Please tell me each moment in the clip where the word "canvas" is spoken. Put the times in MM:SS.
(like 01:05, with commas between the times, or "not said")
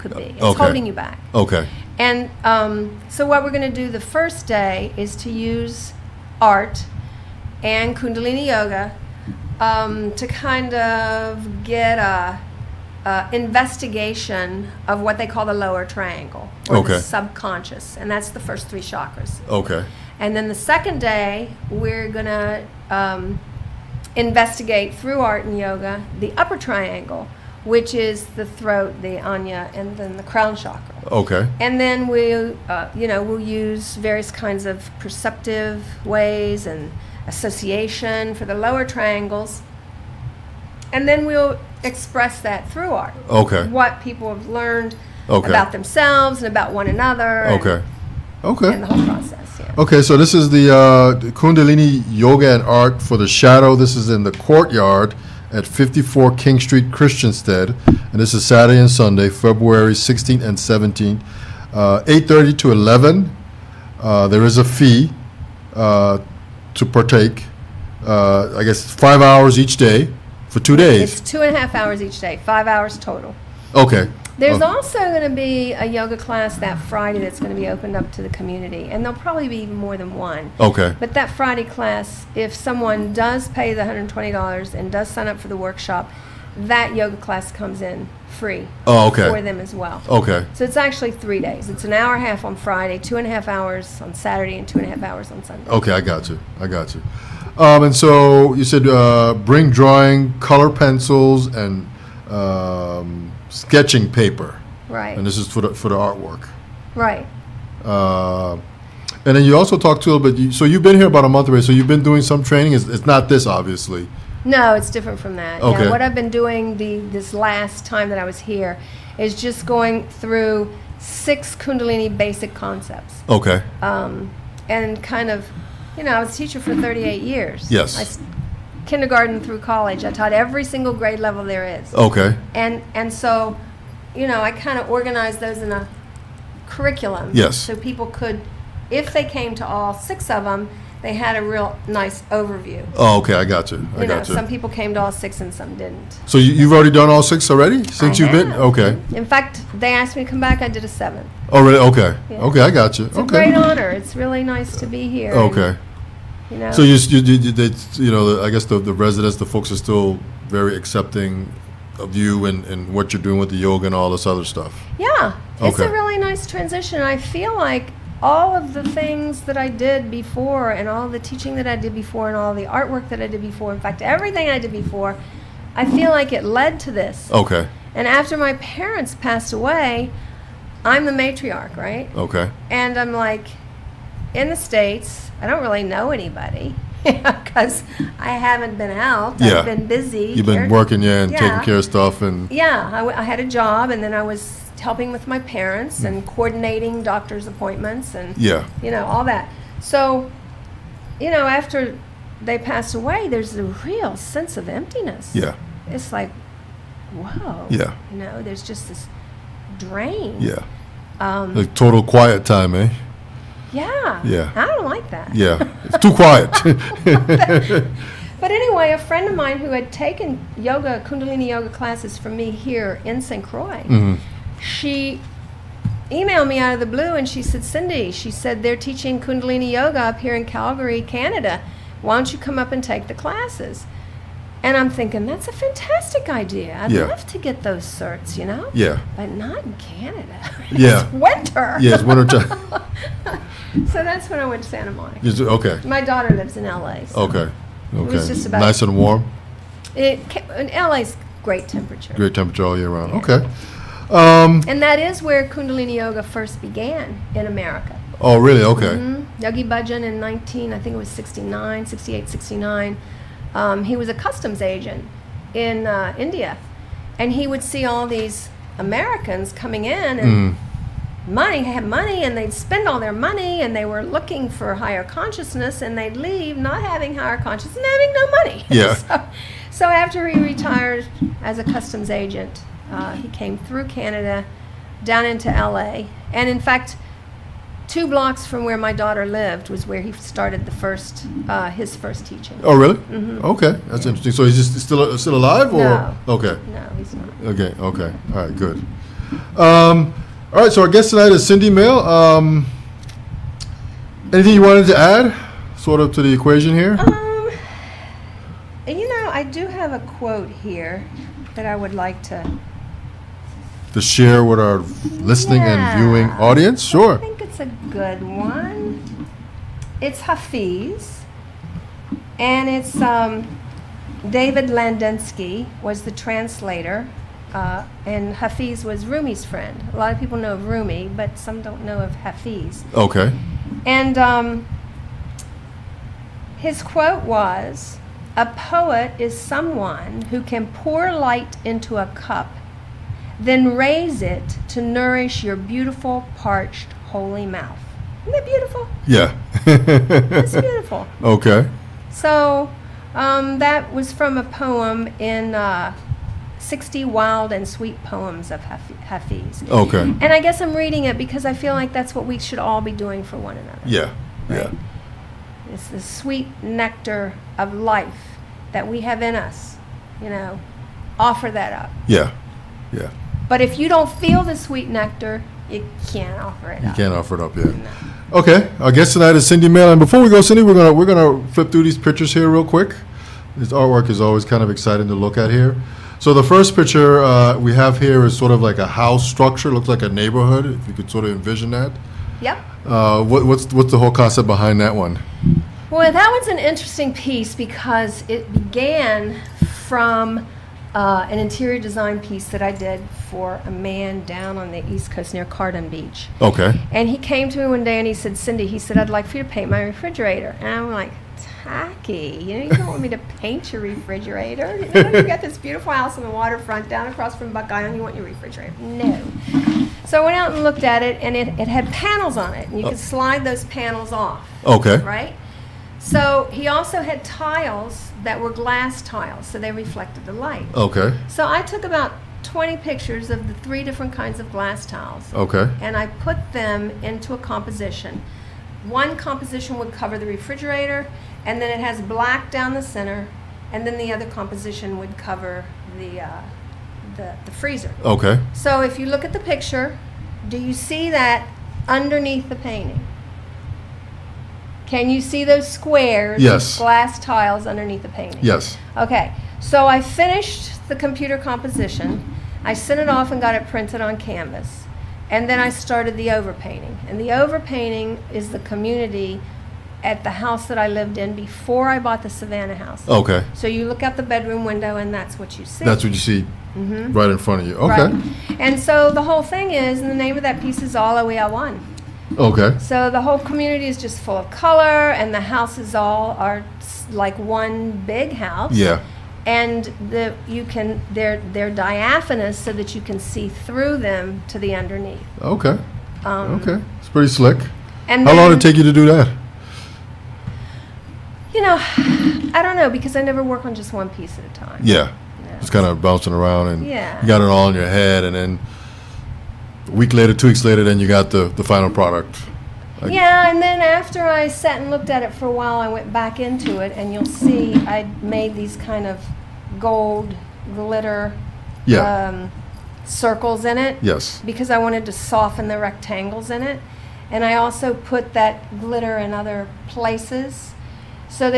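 07:44.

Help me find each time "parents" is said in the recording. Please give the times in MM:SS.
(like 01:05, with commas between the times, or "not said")
02:58, 03:15.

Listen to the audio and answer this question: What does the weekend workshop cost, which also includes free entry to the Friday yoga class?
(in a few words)
$120.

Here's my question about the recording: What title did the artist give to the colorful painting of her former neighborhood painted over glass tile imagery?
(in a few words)
All We Are One.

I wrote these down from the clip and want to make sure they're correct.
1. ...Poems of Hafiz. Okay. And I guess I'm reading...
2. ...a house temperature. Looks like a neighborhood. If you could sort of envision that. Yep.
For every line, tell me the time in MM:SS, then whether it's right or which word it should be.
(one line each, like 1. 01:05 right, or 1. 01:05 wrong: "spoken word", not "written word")
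1. 05:58 right
2. 06:28 wrong: "structure", not "temperature".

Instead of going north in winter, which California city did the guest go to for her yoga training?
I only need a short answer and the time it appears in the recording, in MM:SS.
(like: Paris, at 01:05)
Santa Monica, at 04:04.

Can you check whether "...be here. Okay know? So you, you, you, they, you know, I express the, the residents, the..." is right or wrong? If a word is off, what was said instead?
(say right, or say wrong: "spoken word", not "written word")
wrong: "guess", not "express".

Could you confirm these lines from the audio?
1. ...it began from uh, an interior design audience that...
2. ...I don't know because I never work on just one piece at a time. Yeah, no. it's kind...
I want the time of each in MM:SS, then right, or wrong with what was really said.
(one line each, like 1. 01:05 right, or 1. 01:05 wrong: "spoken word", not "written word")
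1. 06:38 wrong: "piece", not "audience"
2. 08:22 right.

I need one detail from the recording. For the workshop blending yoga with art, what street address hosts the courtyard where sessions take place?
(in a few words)
54 King Street.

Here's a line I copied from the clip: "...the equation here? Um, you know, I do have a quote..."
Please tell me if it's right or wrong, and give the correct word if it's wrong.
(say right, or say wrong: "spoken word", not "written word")
right.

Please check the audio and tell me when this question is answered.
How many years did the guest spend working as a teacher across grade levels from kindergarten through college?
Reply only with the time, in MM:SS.
02:06.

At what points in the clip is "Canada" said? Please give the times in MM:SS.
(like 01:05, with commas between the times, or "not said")
03:51, 03:59, 04:43.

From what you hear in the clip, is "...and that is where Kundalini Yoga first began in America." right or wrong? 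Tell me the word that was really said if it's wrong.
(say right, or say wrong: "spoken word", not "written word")
right.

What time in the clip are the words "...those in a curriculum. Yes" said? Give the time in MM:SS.
02:15.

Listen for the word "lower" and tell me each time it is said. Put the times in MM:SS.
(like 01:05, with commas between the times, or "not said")
00:15, 00:38.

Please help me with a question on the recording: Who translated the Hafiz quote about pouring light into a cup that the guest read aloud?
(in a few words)
David Ladinsky.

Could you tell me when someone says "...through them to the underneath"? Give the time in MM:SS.
08:13.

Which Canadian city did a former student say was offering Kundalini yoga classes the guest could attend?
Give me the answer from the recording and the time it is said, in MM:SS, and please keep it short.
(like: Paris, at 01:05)
Calgary, at 03:50.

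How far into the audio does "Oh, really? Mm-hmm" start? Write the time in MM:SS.
04:52.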